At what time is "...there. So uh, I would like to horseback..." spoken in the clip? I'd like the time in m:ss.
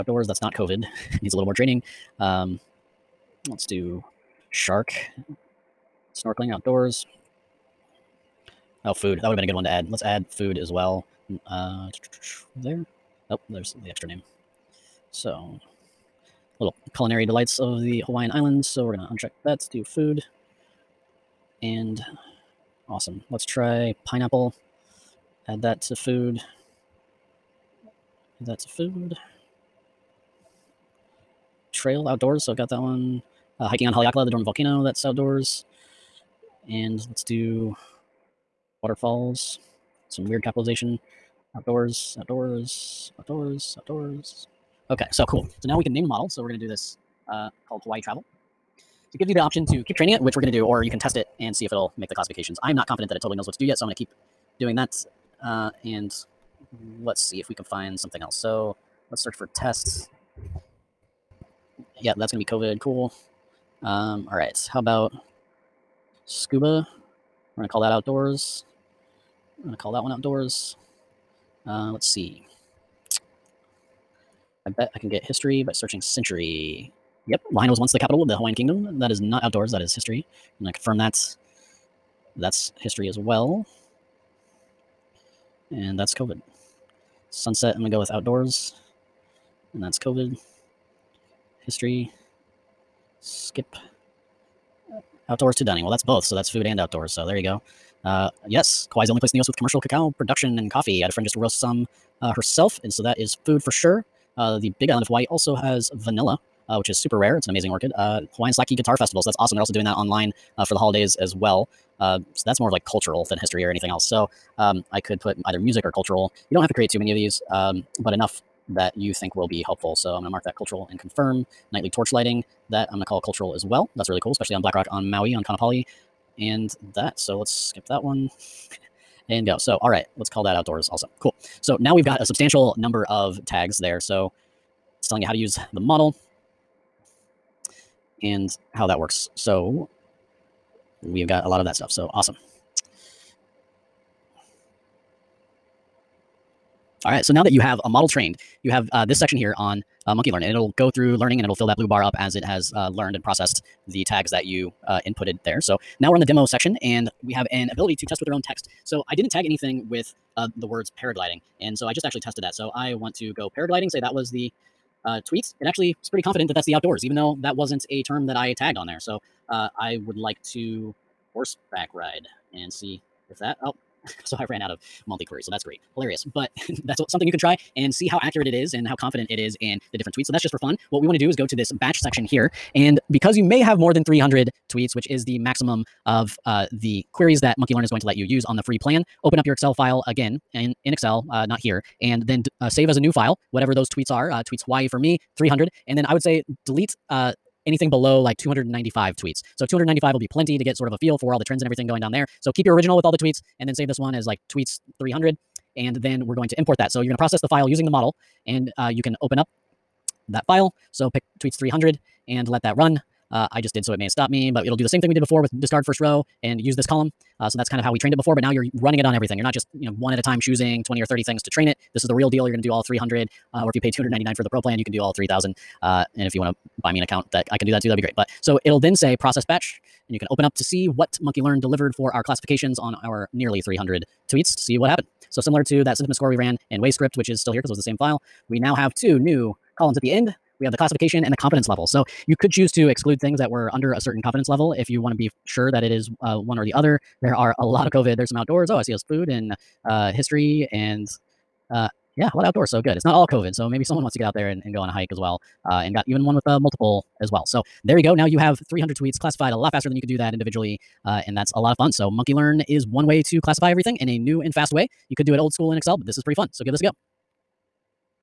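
2:48.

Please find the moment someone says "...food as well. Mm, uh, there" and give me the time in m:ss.
0:10.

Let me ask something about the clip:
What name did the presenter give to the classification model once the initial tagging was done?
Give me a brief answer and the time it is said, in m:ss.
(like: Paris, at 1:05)
Hawaii Travel, at 0:47.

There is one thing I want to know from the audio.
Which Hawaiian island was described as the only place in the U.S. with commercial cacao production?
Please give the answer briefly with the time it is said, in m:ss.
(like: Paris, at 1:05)
Kauai, at 1:38.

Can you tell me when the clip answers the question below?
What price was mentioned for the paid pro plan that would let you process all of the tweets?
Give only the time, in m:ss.
3:43.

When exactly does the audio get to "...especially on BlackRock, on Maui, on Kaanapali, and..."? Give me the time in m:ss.
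2:04.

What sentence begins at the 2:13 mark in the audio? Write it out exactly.
So it's telling you how to use the model and how that works.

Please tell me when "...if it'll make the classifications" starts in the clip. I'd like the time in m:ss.
0:51.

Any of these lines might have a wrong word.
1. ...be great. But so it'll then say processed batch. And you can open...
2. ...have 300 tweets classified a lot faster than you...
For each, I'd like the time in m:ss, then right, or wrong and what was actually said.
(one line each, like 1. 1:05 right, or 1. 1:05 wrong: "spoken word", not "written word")
1. 3:47 right
2. 4:18 right.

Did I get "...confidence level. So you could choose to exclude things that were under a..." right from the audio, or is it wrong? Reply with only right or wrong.
right.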